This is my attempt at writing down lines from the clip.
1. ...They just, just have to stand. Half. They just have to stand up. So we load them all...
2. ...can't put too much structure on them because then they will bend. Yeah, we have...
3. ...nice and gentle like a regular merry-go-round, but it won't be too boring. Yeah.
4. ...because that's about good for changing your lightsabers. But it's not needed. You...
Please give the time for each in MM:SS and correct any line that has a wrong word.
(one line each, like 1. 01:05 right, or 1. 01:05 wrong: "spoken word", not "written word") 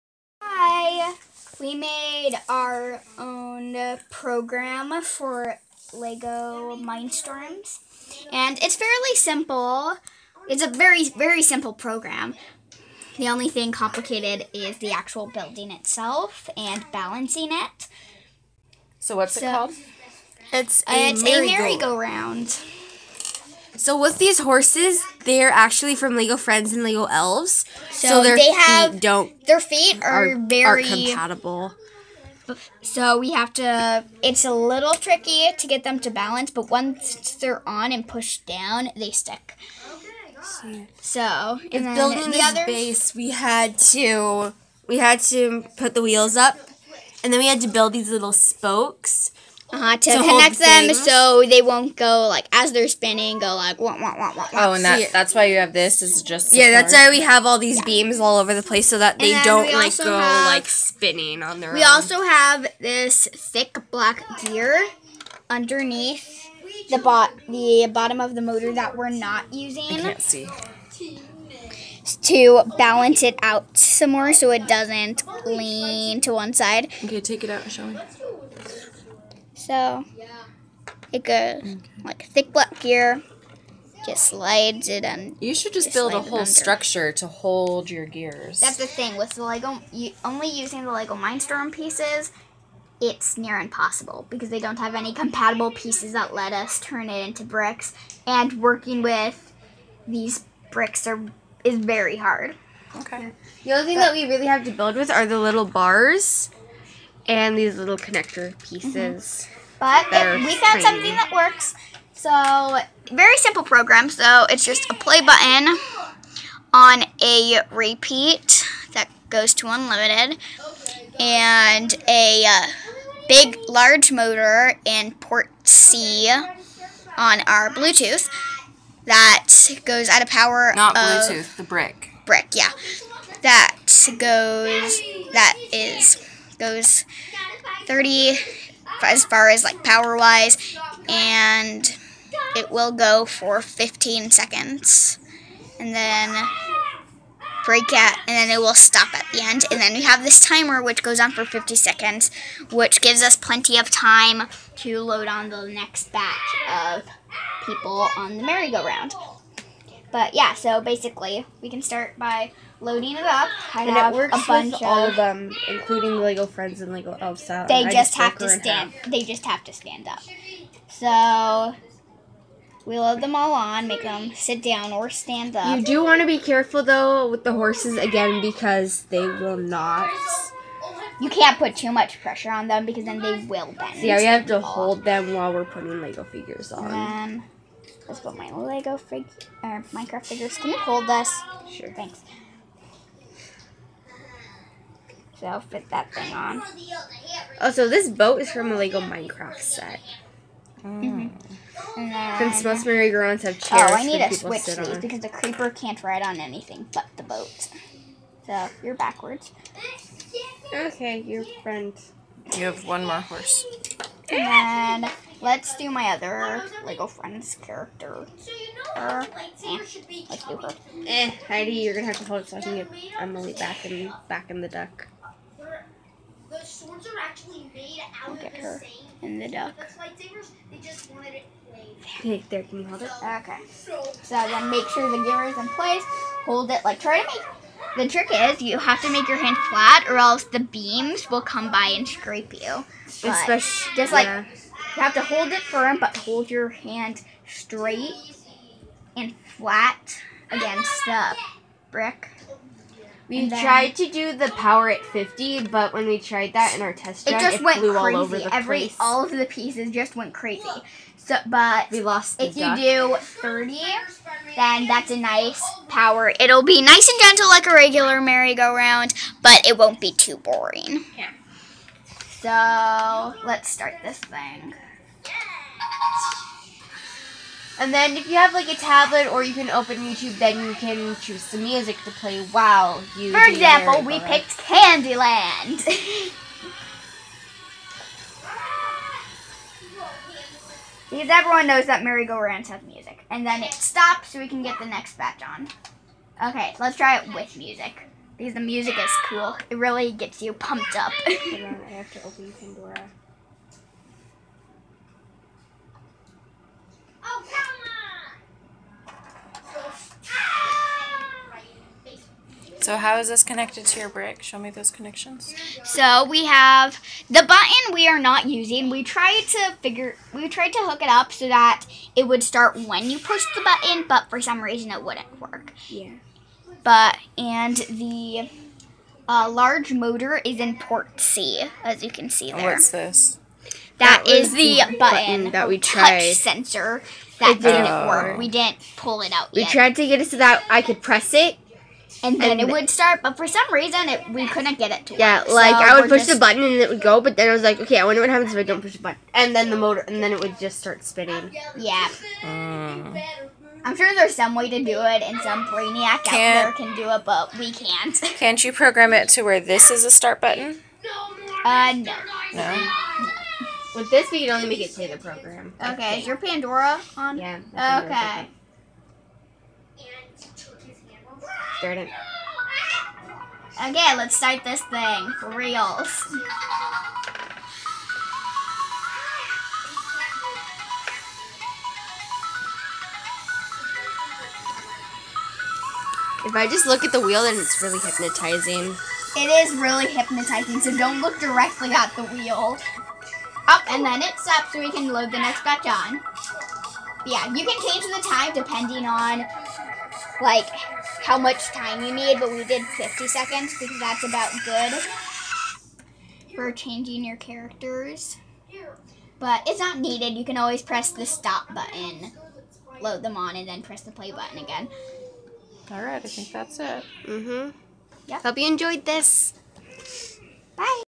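1. 02:47 right
2. 03:01 wrong: "pressure", not "structure"
3. 04:26 right
4. 06:43 wrong: "characters", not "lightsabers".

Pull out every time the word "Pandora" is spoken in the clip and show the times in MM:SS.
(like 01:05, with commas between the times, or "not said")
05:02, 06:06.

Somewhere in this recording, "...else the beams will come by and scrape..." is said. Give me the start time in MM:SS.
04:00.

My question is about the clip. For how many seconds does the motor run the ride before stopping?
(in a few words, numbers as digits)
15.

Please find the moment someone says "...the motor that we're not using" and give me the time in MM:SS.
01:08.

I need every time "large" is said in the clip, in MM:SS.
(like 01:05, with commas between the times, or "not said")
02:03, 05:29.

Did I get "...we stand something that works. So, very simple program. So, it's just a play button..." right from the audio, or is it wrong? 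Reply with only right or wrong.
wrong.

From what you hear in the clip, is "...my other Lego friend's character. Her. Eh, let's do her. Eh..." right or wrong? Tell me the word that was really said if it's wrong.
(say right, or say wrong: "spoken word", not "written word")
right.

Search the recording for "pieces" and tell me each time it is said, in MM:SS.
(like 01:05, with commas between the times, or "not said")
01:31, 01:35, 01:48, 04:19.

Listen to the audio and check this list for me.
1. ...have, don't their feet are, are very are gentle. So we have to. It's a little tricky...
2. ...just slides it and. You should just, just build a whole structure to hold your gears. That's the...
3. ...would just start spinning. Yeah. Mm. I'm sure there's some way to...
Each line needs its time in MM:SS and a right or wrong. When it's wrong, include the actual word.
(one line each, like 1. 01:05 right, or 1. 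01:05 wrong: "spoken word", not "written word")
1. 00:28 wrong: "compatible", not "gentle"
2. 01:24 right
3. 05:50 right.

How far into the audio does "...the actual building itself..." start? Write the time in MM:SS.
00:14.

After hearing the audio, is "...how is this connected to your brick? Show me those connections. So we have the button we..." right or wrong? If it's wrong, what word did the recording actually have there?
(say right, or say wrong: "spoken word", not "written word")
right.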